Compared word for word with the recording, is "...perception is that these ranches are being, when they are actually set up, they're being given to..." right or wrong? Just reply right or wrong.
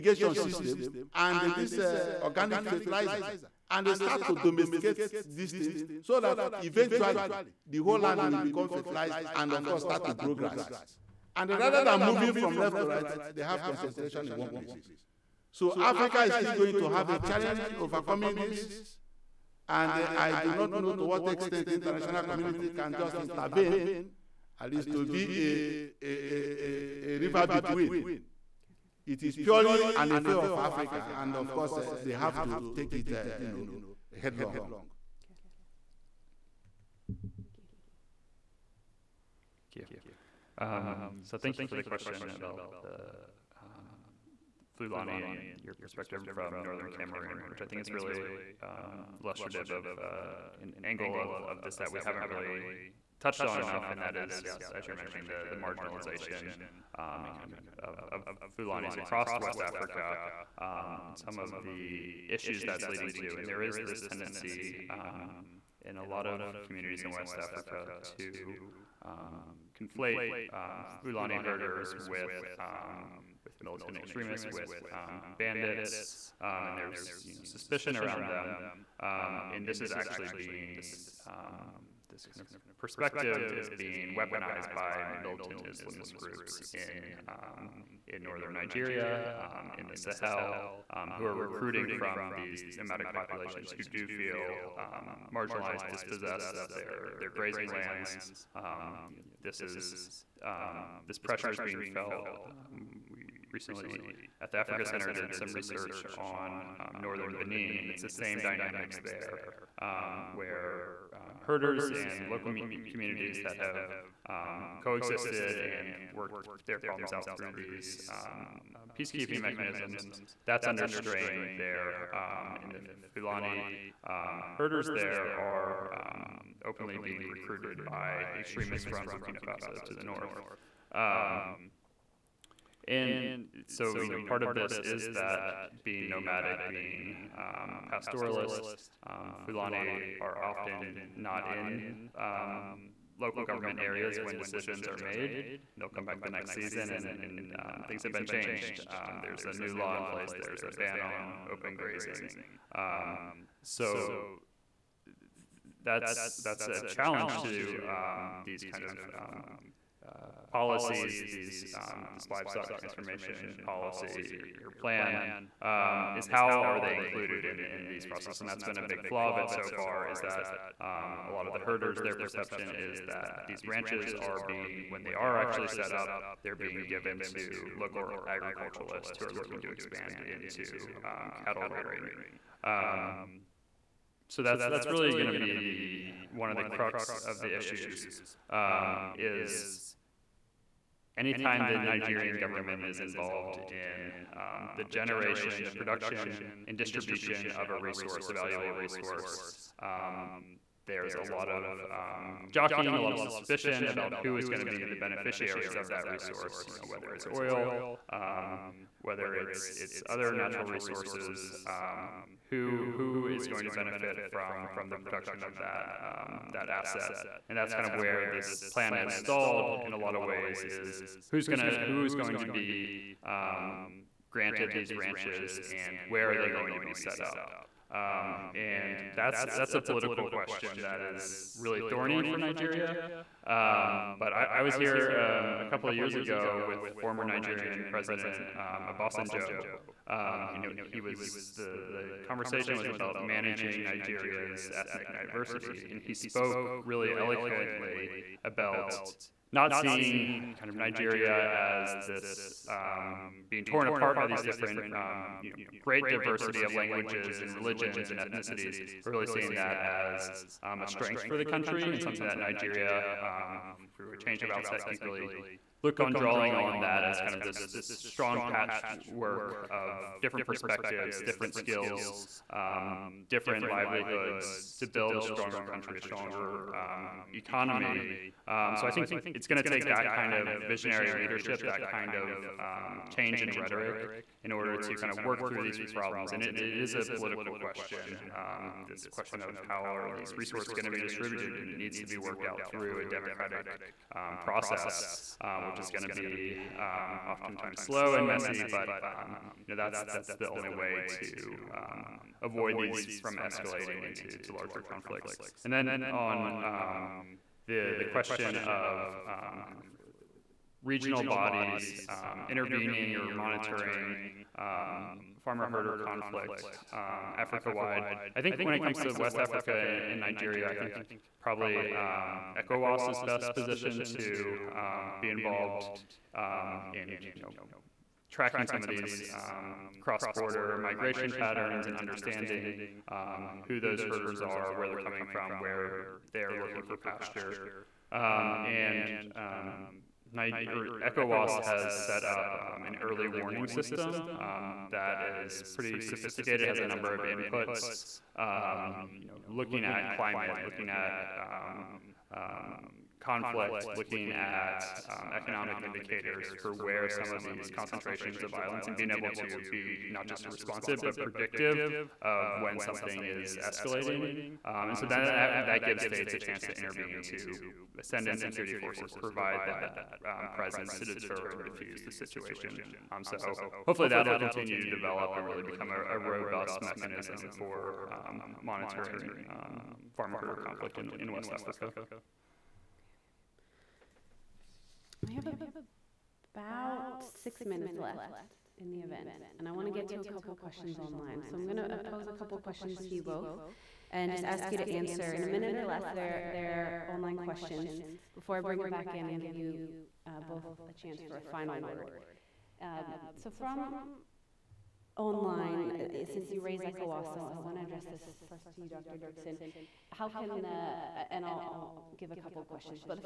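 right.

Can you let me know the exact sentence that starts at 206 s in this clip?
You know, whether it's oil, um, whether it's it's other natural resources.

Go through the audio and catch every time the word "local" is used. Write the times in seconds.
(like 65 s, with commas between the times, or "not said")
112 s, 143 s, 177 s.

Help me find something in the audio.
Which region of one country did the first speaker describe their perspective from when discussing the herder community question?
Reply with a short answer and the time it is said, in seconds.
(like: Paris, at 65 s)
Northern Cameroon, at 46 s.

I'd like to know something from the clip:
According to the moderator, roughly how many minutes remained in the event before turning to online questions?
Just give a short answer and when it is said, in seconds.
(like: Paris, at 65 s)
6, at 387 s.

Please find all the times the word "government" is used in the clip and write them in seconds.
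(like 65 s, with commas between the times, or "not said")
143 s, 192 s.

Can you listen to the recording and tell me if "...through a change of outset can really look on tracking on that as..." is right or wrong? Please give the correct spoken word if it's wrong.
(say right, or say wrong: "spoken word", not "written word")
wrong: "drawing", not "tracking".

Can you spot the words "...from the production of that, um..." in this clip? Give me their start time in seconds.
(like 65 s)
214 s.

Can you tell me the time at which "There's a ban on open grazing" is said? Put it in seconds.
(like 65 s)
150 s.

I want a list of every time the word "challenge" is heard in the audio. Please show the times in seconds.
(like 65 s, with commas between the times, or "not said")
17 s, 156 s.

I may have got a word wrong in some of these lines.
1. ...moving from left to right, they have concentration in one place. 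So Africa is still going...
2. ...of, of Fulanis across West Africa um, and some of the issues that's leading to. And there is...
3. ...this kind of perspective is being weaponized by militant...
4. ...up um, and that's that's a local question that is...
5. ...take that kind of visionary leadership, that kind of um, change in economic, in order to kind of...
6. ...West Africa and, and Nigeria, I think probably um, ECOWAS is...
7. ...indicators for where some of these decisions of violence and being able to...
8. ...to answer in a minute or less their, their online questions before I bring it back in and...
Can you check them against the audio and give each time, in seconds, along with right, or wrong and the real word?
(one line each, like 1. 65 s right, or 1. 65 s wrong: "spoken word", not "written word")
1. 12 s right
2. 57 s right
3. 82 s right
4. 227 s wrong: "political", not "local"
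5. 279 s wrong: "rhetoric", not "economic"
6. 319 s right
7. 355 s wrong: "concentrations", not "decisions"
8. 394 s right.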